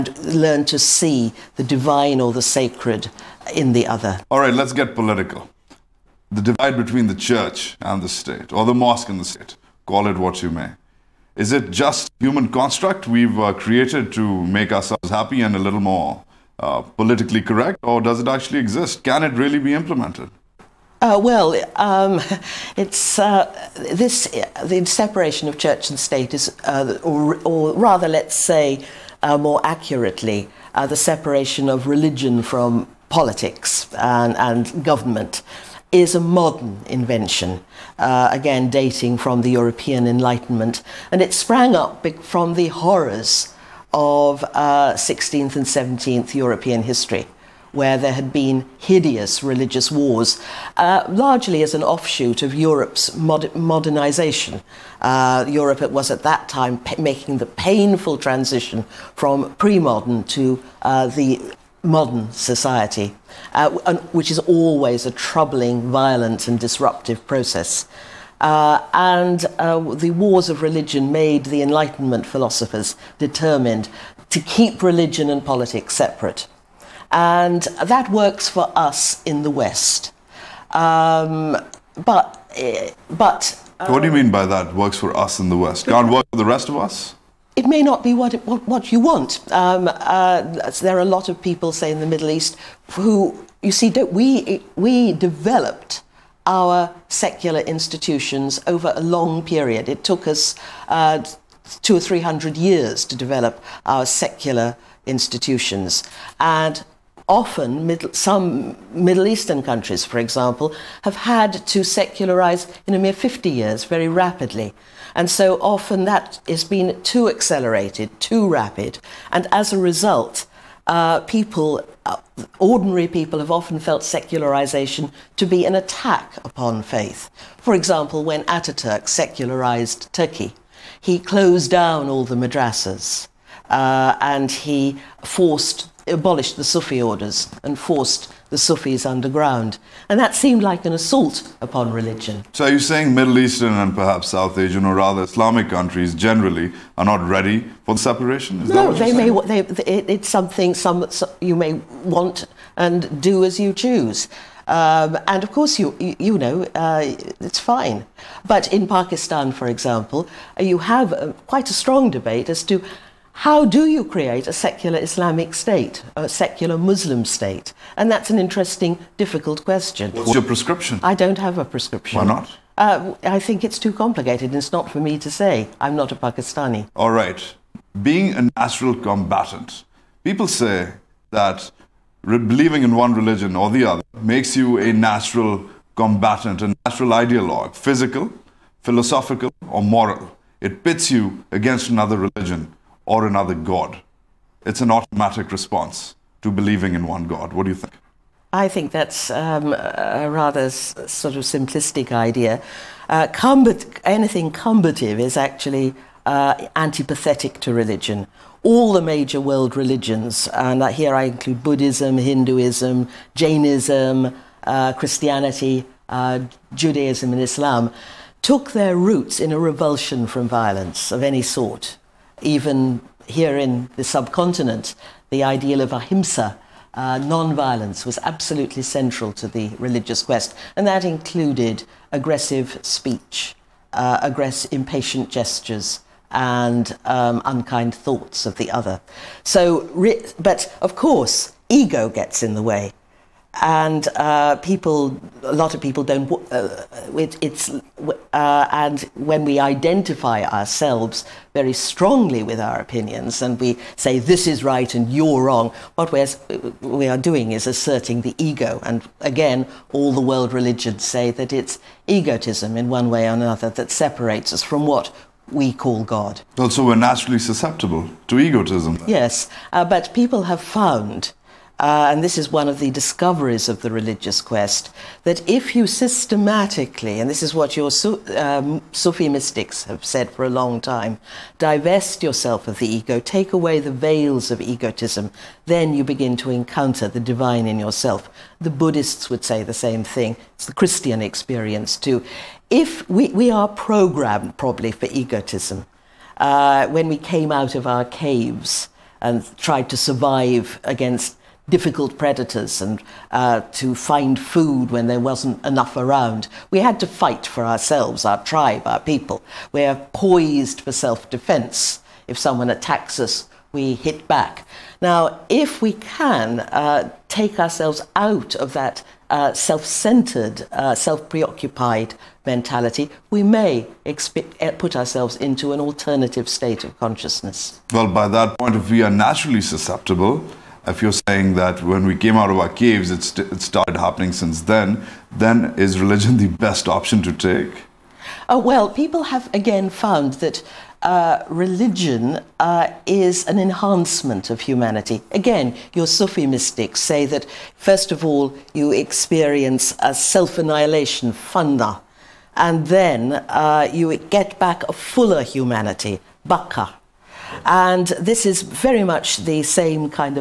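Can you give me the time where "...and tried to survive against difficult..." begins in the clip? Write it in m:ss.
4:59.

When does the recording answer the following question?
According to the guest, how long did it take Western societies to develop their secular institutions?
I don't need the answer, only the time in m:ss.
1:41.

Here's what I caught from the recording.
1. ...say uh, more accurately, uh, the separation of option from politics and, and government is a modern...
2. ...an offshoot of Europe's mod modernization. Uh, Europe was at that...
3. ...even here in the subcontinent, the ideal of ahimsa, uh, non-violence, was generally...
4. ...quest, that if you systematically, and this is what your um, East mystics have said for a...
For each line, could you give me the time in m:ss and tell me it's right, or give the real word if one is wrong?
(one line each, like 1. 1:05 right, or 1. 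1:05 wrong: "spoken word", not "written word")
1. 0:28 wrong: "religion", not "option"
2. 0:51 right
3. 3:42 wrong: "absolutely", not "generally"
4. 4:34 wrong: "Sufi", not "East".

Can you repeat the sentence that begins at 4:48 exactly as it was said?
The Buddhists would say the same thing.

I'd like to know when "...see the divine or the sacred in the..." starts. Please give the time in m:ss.
0:00.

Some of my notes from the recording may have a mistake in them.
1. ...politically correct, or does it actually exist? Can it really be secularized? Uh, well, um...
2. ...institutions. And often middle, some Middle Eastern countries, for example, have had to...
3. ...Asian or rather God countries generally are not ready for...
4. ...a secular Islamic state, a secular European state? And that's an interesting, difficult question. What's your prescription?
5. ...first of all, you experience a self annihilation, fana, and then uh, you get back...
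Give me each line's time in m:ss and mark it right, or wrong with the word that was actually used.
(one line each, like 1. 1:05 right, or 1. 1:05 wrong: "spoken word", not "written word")
1. 0:16 wrong: "implemented", not "secularized"
2. 1:45 right
3. 2:24 wrong: "Islamic", not "God"
4. 2:44 wrong: "Muslim", not "European"
5. 5:47 right.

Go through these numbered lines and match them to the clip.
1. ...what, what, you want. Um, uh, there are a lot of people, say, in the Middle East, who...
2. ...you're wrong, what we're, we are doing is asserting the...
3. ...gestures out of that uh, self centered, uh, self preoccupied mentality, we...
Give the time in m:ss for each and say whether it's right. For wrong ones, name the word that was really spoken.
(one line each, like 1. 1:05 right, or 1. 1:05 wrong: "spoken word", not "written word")
1. 1:28 right
2. 4:15 right
3. 5:17 wrong: "ourselves", not "gestures".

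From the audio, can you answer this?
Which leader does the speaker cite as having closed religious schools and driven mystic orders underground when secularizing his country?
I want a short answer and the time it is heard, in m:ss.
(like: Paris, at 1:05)
Ataturk, at 2:08.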